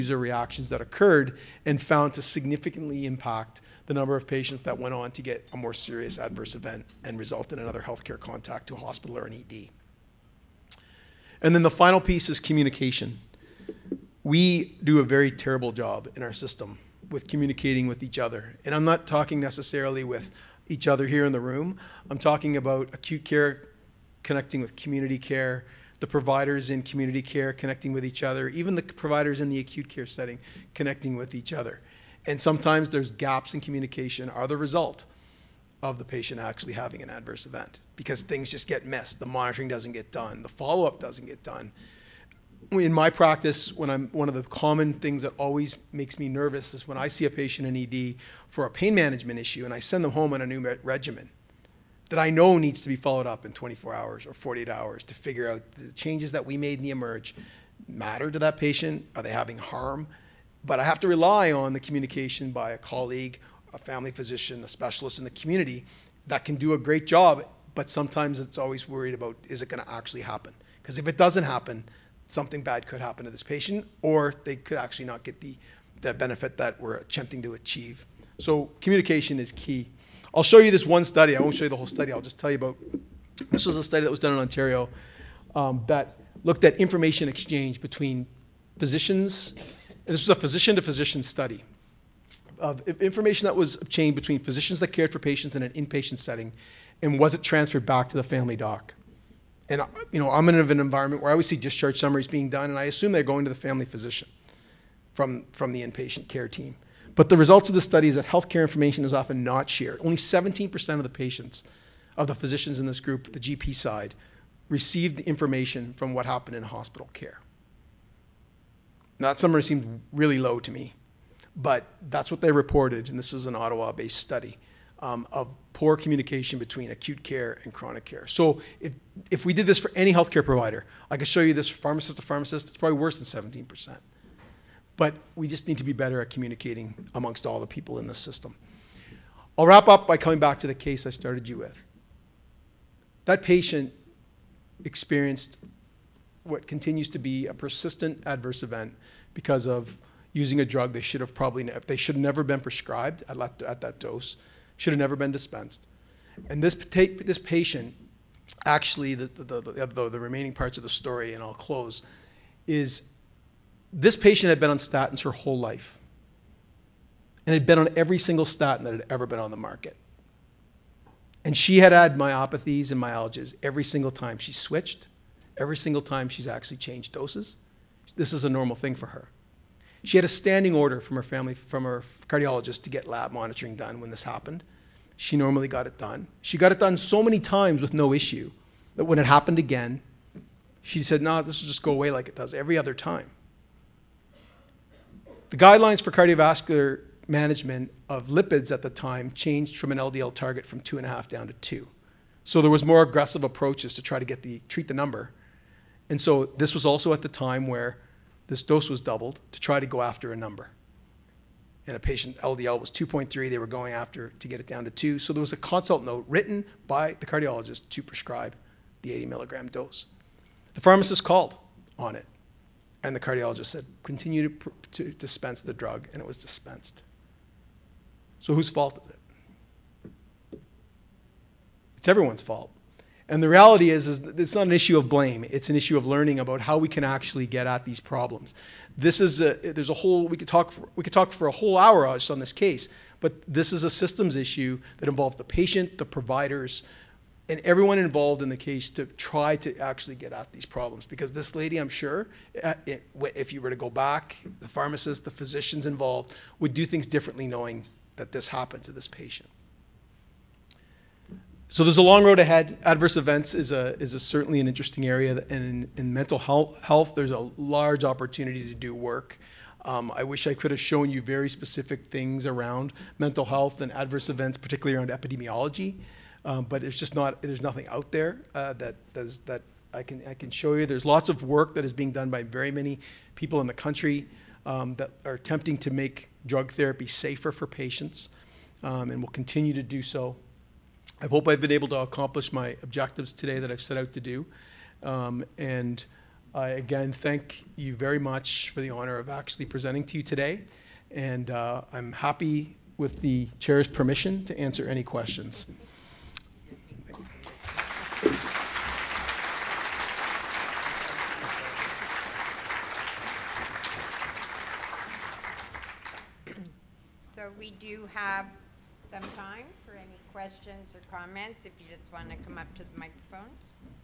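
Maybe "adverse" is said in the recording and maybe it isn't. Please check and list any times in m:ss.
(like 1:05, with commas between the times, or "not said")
0:06, 0:37, 2:28, 4:22, 4:33.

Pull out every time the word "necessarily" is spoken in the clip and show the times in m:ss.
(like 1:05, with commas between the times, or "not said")
0:19.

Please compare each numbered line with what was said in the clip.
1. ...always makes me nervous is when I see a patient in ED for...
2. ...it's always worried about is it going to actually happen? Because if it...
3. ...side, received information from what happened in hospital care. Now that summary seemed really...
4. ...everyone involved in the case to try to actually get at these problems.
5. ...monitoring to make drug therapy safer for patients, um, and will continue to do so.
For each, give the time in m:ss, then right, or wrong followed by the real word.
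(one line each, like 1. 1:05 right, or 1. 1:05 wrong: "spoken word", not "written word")
1. 0:45 right
2. 1:08 right
3. 1:53 right
4. 4:07 right
5. 4:45 wrong: "attempting", not "monitoring".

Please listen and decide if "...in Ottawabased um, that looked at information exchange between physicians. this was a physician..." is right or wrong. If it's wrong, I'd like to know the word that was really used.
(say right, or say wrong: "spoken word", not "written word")
wrong: "Ontario", not "Ottawabased".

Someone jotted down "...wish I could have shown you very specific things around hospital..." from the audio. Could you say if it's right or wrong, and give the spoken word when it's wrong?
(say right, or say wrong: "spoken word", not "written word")
wrong: "mental", not "hospital".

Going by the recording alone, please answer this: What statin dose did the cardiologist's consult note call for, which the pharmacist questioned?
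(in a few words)
80 milligrams.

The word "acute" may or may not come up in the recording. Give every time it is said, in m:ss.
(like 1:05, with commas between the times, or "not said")
0:22, 0:29, 2:06.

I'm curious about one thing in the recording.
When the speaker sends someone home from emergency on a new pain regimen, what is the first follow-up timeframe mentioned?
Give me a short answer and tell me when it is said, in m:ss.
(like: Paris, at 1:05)
24 hours, at 0:53.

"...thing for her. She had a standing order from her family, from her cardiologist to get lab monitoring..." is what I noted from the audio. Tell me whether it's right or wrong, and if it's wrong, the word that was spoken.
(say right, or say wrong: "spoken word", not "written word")
right.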